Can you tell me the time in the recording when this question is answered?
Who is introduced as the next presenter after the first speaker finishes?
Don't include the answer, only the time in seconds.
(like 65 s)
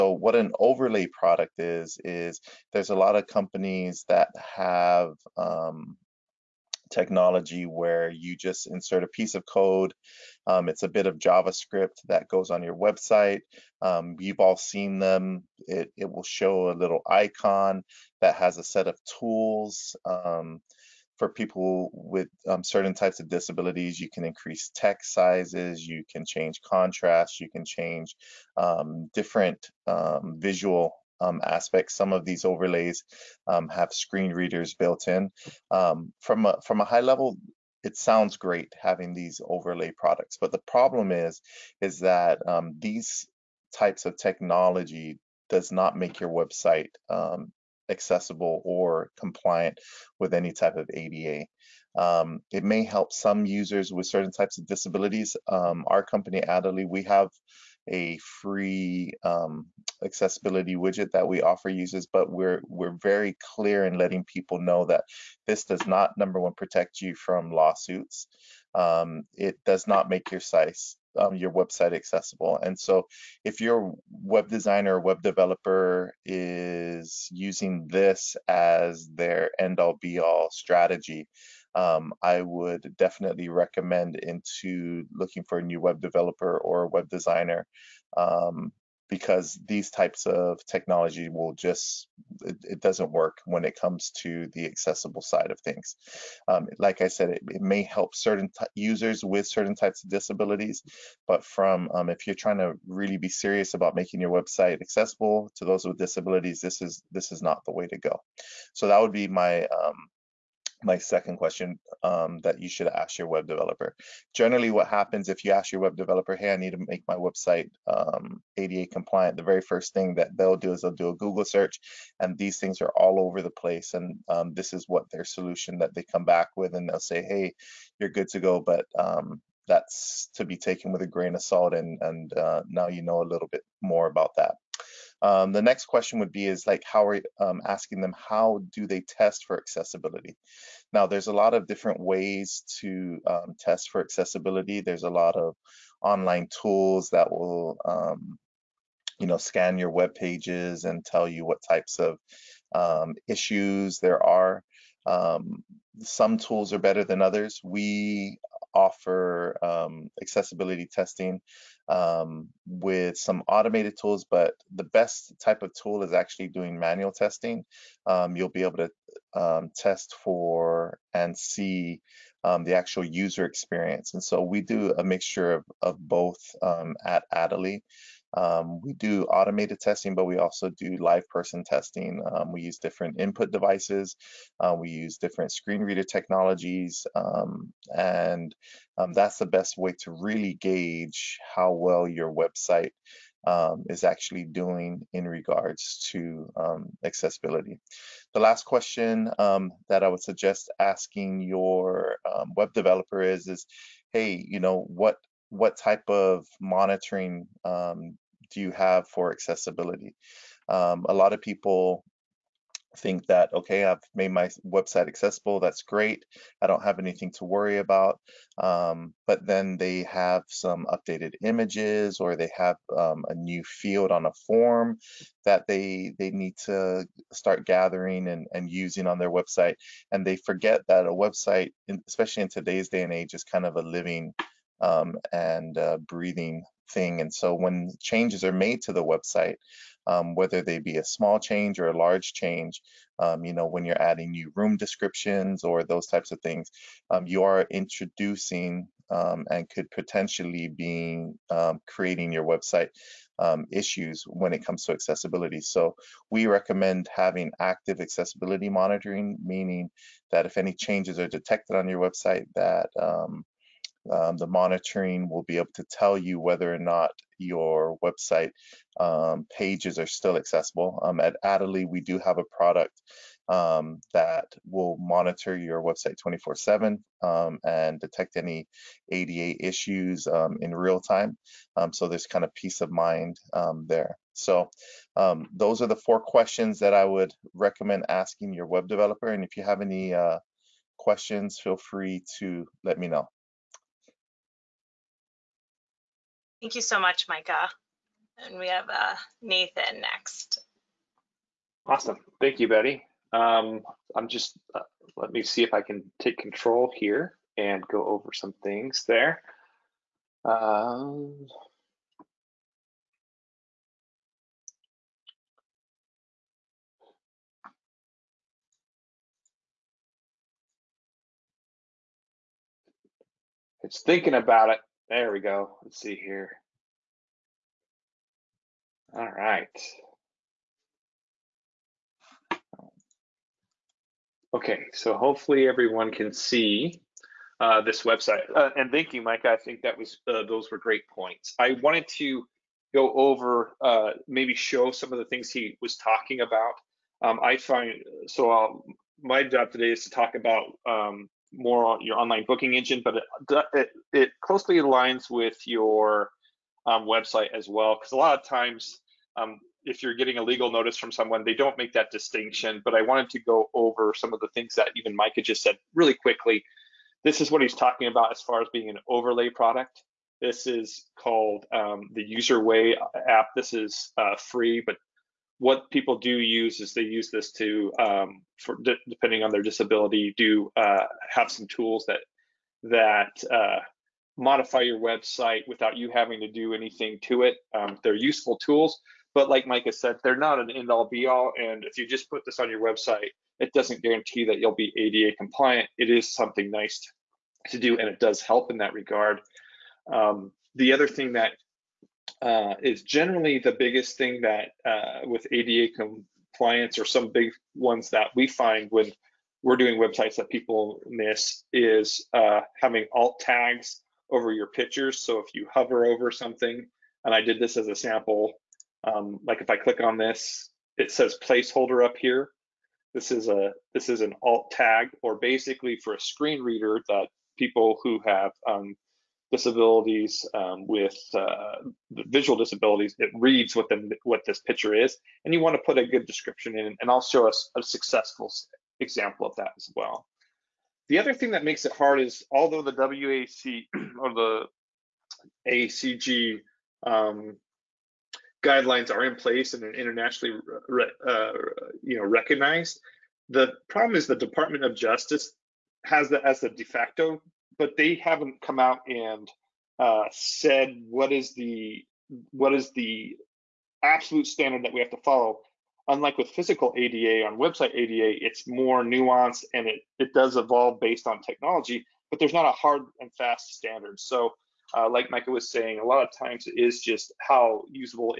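299 s.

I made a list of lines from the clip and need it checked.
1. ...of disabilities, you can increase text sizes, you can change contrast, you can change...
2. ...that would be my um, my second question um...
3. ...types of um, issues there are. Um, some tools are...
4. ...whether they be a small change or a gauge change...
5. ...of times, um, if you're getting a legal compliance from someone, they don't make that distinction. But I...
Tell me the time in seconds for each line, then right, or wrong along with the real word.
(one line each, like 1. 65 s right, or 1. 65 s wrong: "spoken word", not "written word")
1. 23 s right
2. 108 s right
3. 151 s right
4. 240 s wrong: "large", not "gauge"
5. 358 s wrong: "notice", not "compliance".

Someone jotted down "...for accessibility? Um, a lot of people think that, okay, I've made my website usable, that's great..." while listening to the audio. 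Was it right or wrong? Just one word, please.
wrong.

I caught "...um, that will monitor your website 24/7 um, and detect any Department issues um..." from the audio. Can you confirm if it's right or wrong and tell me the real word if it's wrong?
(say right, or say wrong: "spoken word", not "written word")
wrong: "ADA", not "Department".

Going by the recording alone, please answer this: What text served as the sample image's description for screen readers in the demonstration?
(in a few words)
placeholder.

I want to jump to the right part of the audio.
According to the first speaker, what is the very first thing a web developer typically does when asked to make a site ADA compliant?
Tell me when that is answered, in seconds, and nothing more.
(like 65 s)
121 s.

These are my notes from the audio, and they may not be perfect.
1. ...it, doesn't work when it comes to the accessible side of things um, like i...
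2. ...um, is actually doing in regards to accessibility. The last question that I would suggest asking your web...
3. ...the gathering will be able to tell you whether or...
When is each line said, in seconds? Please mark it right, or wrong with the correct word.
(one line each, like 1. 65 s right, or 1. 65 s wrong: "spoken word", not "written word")
1. 92 s right
2. 193 s right
3. 264 s wrong: "monitoring", not "gathering".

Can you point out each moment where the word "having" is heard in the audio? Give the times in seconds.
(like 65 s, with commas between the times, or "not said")
38 s, 257 s, 386 s, 412 s.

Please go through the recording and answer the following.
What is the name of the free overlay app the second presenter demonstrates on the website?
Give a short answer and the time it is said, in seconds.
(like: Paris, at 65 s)
UserWay, at 372 s.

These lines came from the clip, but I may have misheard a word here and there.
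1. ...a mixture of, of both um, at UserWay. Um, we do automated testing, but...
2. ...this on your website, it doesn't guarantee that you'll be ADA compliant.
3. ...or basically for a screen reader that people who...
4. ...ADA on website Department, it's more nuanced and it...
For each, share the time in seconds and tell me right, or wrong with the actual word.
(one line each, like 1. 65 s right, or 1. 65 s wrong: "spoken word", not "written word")
1. 174 s wrong: "Adally", not "UserWay"
2. 392 s right
3. 425 s right
4. 466 s wrong: "ADA", not "Department".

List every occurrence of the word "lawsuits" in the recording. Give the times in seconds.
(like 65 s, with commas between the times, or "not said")
67 s.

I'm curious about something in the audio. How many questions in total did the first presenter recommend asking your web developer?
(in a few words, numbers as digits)
4.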